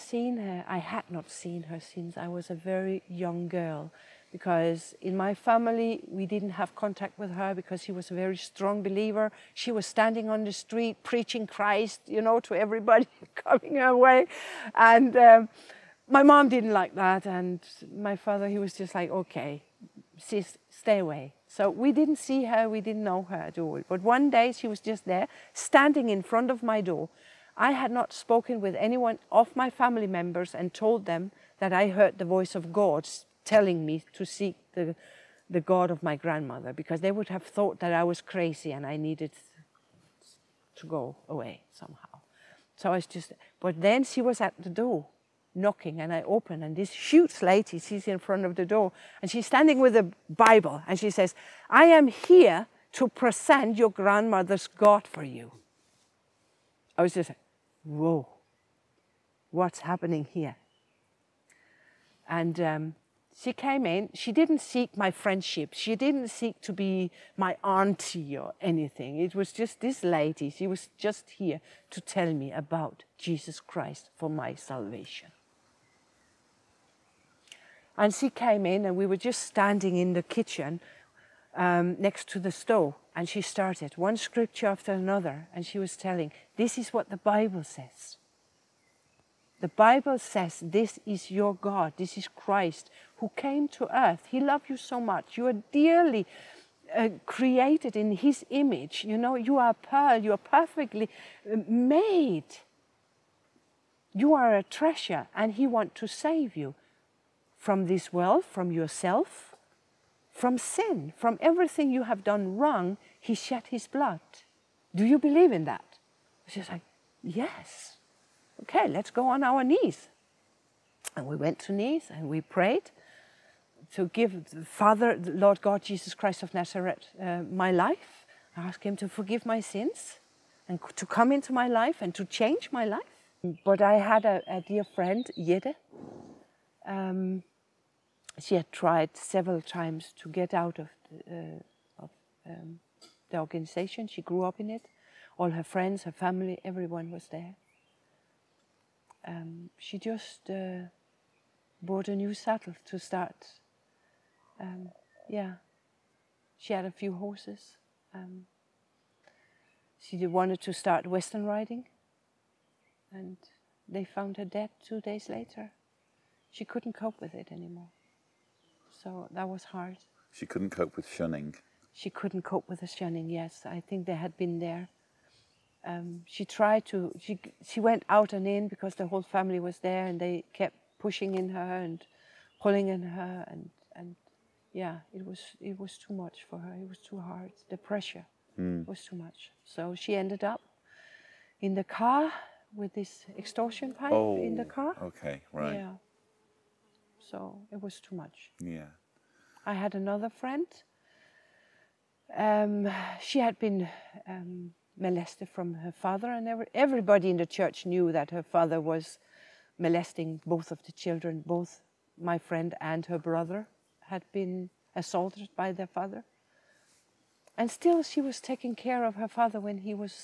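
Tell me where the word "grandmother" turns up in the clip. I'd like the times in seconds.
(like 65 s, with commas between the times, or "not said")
36 s, 53 s.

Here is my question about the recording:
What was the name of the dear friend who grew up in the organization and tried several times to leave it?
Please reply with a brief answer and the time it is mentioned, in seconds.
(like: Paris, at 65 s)
Yede, at 135 s.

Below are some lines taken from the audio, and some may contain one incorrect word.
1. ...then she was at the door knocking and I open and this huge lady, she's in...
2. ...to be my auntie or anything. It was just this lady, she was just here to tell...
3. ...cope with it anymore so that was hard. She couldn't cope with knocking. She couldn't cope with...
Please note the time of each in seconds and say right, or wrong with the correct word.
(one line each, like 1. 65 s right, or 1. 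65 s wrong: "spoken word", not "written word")
1. 43 s right
2. 66 s right
3. 166 s wrong: "shunning", not "knocking".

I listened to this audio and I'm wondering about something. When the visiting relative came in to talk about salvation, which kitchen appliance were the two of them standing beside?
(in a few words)
stove.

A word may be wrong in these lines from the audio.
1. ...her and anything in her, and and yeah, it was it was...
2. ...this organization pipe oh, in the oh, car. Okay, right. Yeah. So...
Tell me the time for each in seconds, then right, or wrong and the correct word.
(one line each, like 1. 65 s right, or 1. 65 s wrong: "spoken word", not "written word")
1. 181 s wrong: "pulling", not "anything"
2. 192 s wrong: "extortion", not "organization".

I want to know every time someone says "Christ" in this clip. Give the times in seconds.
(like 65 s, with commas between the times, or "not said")
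11 s, 73 s, 92 s, 126 s.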